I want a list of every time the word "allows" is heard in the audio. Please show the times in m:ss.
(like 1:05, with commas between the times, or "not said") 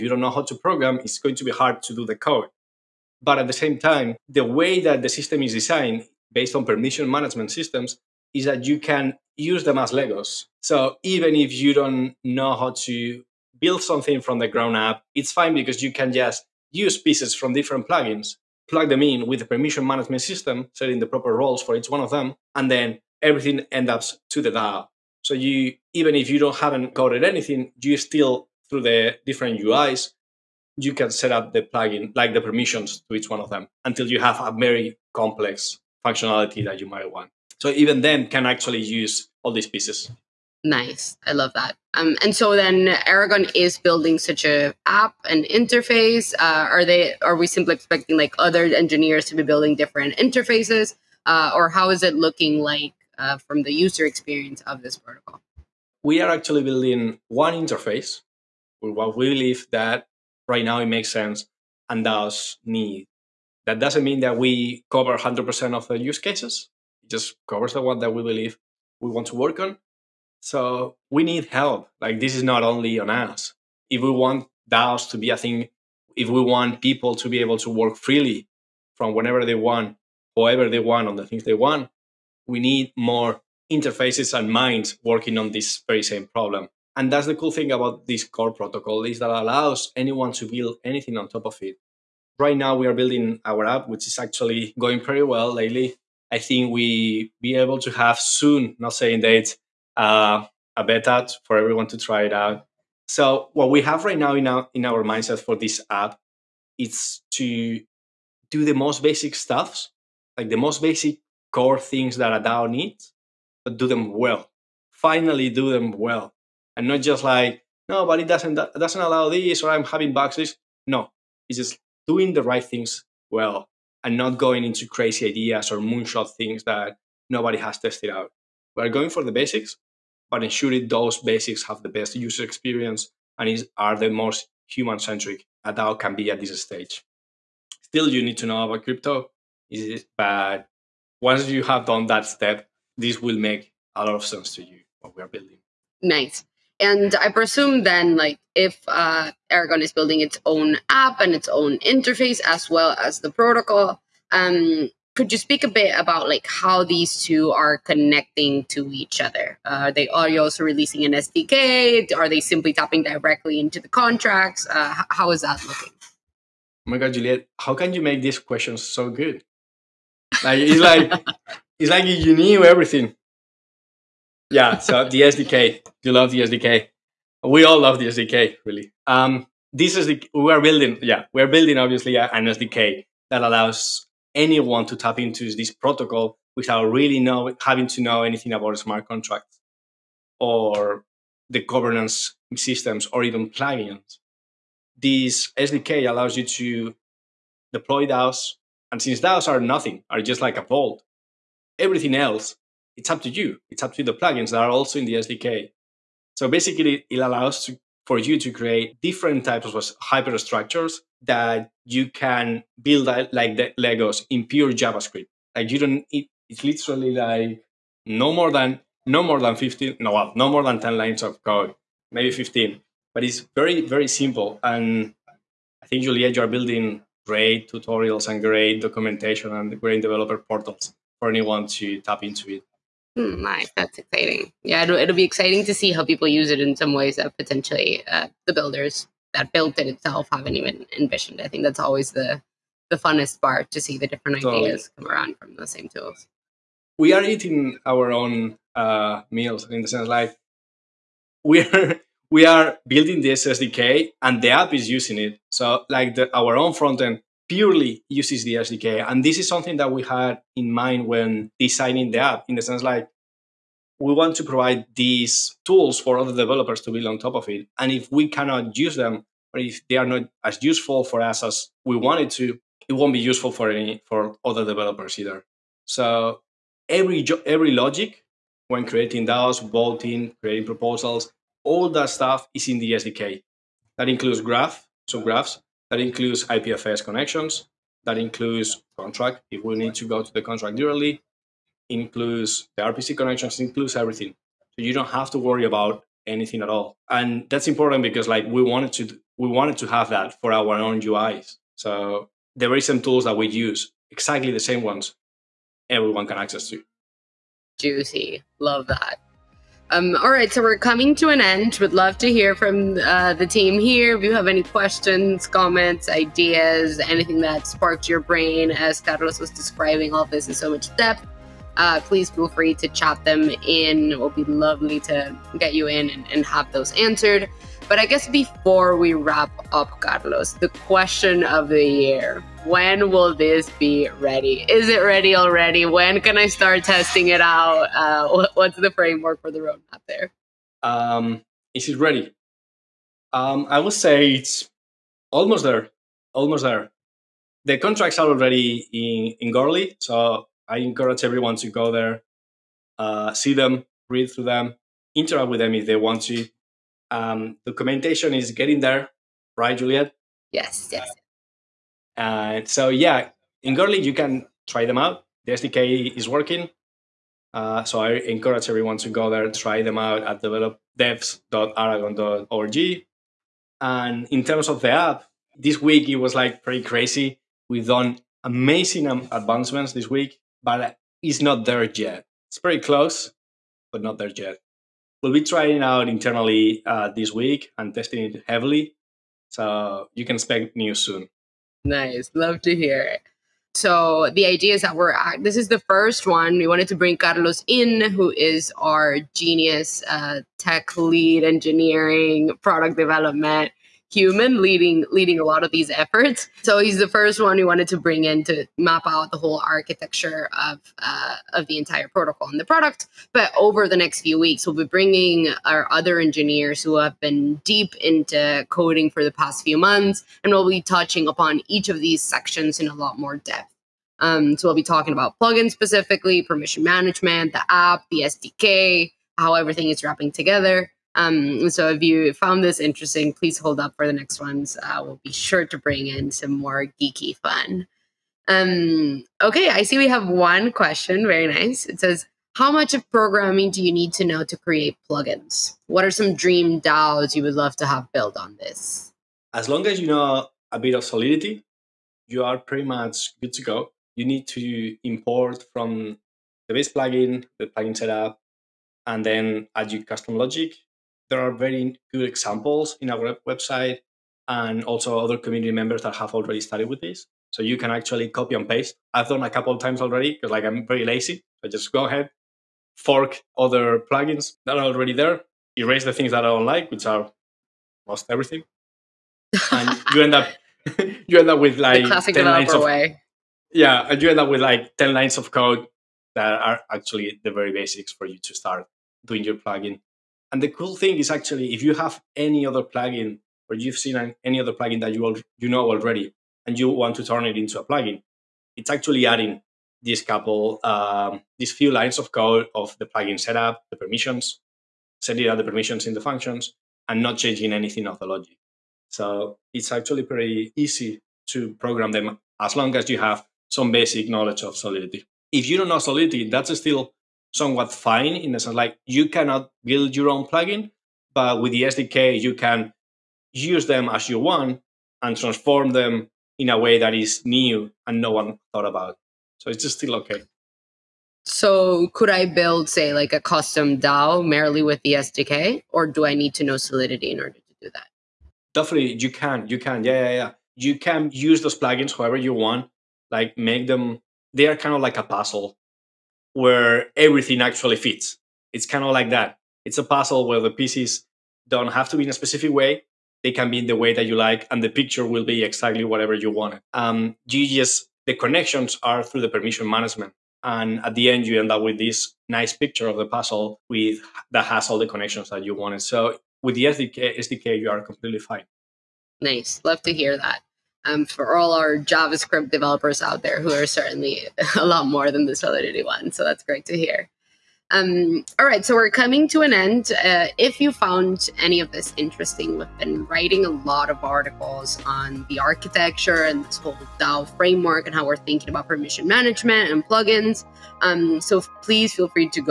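1:29, 1:59, 3:03, 3:16, 3:27.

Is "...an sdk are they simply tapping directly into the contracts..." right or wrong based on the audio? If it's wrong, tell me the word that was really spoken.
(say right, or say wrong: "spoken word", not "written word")
right.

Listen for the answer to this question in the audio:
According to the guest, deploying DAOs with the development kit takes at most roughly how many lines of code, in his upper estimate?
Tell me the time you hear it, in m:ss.
3:42.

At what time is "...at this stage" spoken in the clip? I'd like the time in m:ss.
2:16.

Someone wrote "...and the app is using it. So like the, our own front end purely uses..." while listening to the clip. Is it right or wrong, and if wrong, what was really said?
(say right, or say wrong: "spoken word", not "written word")
right.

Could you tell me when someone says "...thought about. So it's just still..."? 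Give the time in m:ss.
8:48.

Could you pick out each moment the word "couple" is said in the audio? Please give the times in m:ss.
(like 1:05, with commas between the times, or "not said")
7:49, 8:20.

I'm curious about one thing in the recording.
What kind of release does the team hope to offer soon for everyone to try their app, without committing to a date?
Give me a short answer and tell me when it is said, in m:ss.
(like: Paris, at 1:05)
A beta, at 1:40.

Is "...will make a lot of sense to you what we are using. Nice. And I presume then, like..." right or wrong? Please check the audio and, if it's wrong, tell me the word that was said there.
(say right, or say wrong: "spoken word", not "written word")
wrong: "building", not "using".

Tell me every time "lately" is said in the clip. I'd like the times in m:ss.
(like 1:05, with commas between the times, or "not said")
1:35.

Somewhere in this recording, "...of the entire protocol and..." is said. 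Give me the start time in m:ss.
6:51.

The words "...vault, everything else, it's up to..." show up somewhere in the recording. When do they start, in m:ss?
3:20.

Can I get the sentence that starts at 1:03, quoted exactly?
That doesn't mean that we cover 100% of the use cases.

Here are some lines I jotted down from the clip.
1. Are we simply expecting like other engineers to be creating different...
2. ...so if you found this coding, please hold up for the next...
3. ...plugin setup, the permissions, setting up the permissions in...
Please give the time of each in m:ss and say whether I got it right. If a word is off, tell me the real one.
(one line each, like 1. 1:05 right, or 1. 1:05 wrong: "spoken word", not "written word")
1. 0:47 wrong: "building", not "creating"
2. 7:11 wrong: "interesting", not "coding"
3. 8:23 right.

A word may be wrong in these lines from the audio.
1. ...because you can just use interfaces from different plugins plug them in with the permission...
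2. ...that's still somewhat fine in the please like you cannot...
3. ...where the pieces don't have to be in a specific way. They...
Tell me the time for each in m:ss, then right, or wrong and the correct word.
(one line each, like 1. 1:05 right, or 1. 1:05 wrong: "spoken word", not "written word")
1. 0:15 wrong: "pieces", not "interfaces"
2. 8:36 wrong: "sense", not "please"
3. 9:10 right.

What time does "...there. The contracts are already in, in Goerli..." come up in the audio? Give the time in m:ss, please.
5:46.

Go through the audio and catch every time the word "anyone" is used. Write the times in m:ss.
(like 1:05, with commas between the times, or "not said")
1:29, 3:04, 3:51.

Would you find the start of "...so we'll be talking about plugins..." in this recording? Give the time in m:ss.
7:04.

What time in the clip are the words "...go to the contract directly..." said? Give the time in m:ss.
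4:50.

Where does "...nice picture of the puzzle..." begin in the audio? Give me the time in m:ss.
9:22.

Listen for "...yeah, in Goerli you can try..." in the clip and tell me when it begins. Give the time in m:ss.
6:02.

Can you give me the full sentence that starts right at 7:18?
Um, okay, I see we have one question.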